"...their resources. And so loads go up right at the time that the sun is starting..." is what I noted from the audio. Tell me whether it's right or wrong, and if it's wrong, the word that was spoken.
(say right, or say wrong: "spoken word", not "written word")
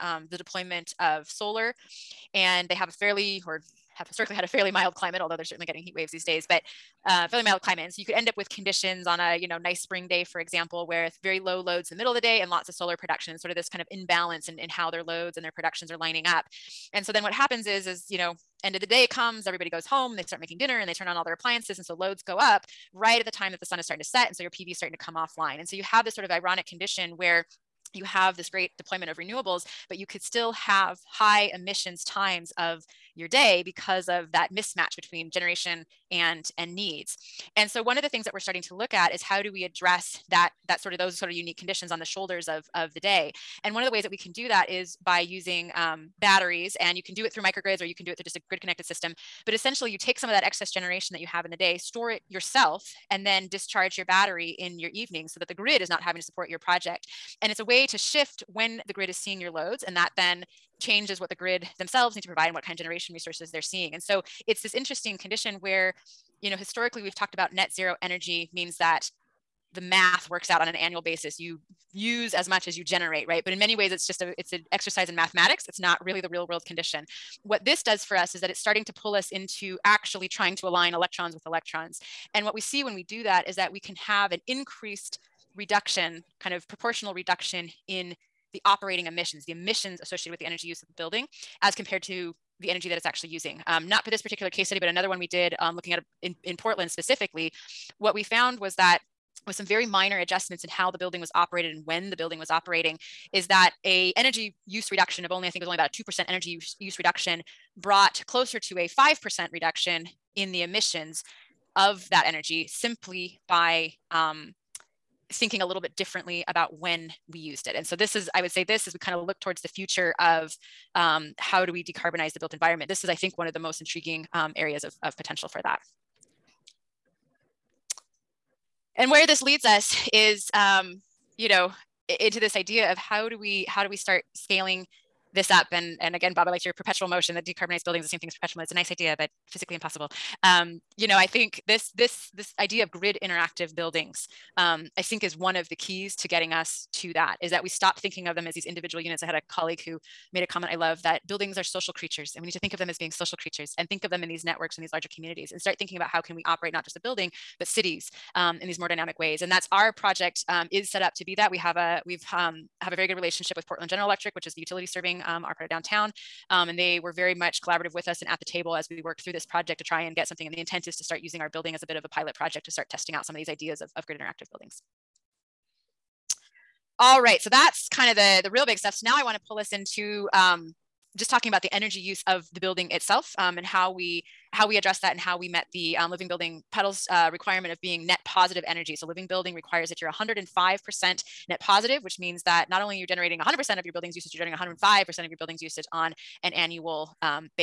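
wrong: "appliances", not "resources".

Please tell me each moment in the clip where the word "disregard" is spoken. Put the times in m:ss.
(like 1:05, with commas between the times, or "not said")
not said.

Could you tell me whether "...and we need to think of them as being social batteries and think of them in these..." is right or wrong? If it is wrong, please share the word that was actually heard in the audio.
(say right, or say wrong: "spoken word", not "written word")
wrong: "creatures", not "batteries".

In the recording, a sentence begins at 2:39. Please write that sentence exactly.
And that's our project um, is set up to be that.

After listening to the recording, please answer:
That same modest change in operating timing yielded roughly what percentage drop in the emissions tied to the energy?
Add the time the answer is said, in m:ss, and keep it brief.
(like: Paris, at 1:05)
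5%, at 1:48.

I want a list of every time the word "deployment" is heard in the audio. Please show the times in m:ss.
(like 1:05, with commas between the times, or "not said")
0:00, 0:28.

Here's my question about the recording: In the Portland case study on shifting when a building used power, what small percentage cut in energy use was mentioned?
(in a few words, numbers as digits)
2%.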